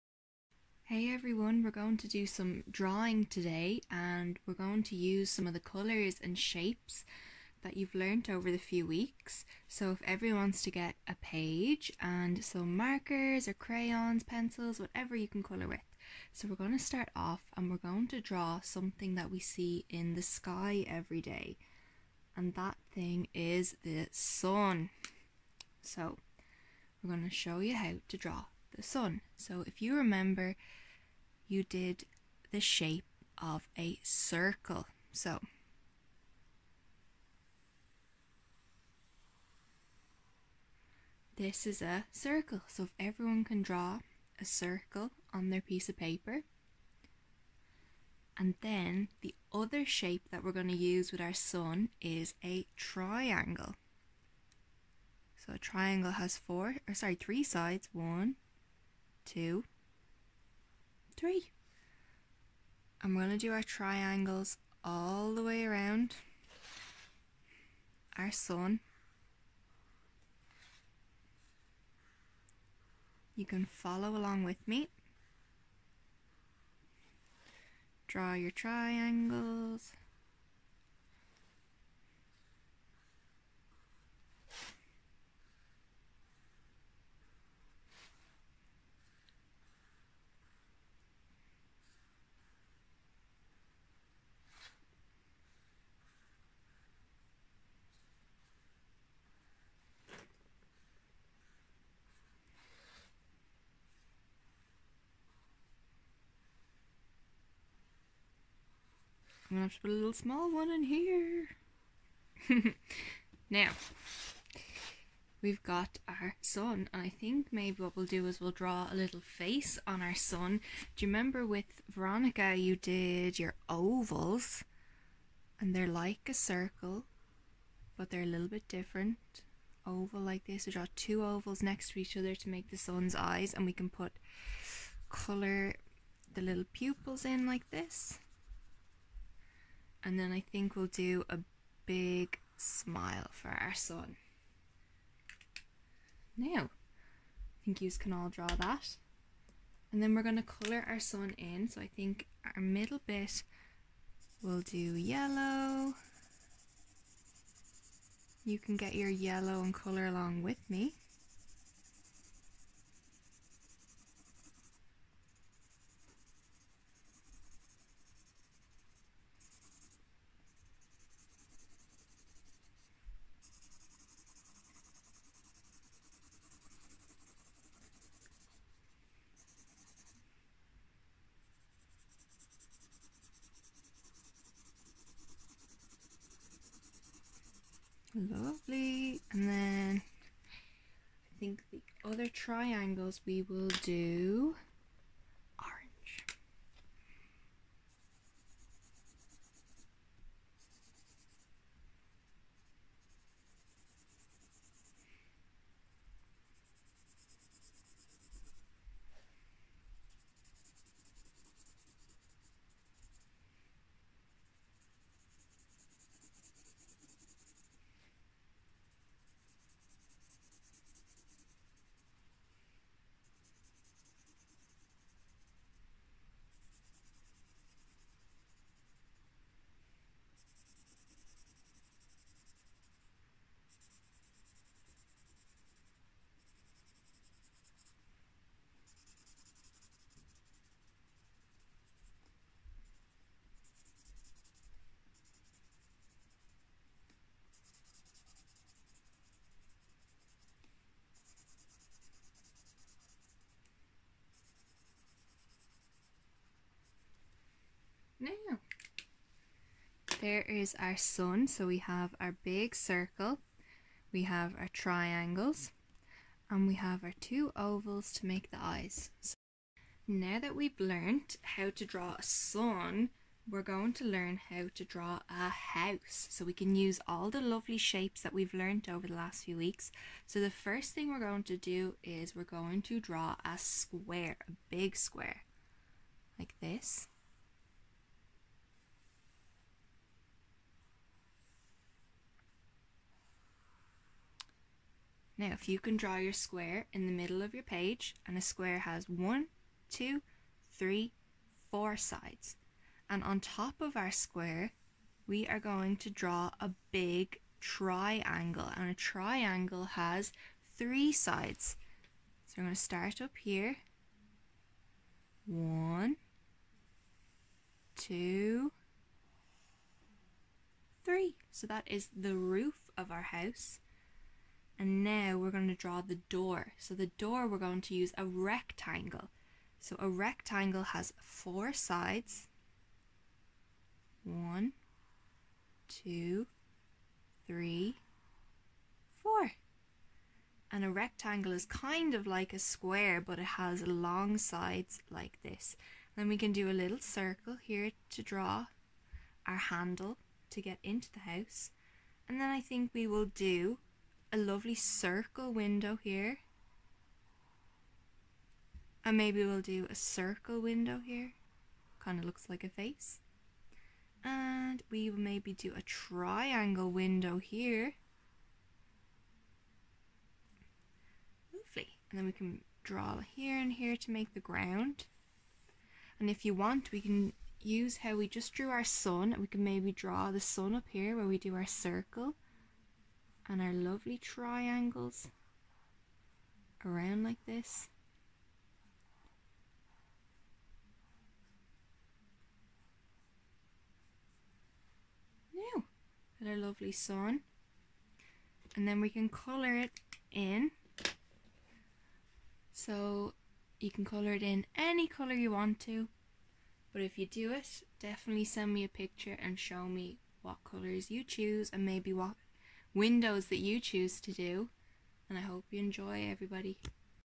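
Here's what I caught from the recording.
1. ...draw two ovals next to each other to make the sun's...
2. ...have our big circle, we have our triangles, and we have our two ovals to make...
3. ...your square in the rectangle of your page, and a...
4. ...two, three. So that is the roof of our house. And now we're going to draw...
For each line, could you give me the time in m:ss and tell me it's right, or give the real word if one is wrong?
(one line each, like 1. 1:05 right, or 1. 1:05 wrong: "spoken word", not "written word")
1. 2:10 right
2. 4:21 right
3. 4:56 wrong: "middle", not "rectangle"
4. 5:17 right.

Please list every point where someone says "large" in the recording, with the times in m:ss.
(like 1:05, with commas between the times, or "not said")
not said.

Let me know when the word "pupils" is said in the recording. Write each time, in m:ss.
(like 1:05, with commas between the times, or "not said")
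2:16.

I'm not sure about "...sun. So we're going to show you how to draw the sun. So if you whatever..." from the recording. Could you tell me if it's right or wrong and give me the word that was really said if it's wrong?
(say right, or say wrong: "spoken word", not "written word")
wrong: "remember", not "whatever".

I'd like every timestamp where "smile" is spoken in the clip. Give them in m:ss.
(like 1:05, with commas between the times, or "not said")
2:22.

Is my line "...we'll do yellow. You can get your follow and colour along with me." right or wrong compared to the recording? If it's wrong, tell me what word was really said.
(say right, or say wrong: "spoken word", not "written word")
wrong: "yellow", not "follow".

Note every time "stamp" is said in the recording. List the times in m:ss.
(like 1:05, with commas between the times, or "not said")
not said.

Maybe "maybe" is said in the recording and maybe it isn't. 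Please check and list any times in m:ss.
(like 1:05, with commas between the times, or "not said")
1:57, 5:59, 6:05, 6:19, 6:51.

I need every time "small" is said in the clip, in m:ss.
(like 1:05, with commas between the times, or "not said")
1:50.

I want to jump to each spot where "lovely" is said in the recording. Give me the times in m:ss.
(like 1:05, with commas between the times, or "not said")
3:08, 4:37, 5:54, 6:11, 6:23, 6:36.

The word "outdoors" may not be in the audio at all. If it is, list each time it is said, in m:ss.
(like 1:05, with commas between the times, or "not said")
not said.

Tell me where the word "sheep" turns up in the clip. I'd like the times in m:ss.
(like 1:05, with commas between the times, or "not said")
not said.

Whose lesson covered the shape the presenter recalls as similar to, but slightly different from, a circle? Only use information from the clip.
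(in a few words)
Veronica.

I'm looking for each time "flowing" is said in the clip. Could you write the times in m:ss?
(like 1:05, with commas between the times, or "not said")
not said.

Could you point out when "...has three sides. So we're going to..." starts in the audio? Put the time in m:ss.
5:09.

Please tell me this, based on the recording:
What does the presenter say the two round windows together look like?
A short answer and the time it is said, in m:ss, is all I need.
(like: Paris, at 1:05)
A face, at 6:02.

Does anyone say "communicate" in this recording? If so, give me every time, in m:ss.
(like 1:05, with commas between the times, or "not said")
not said.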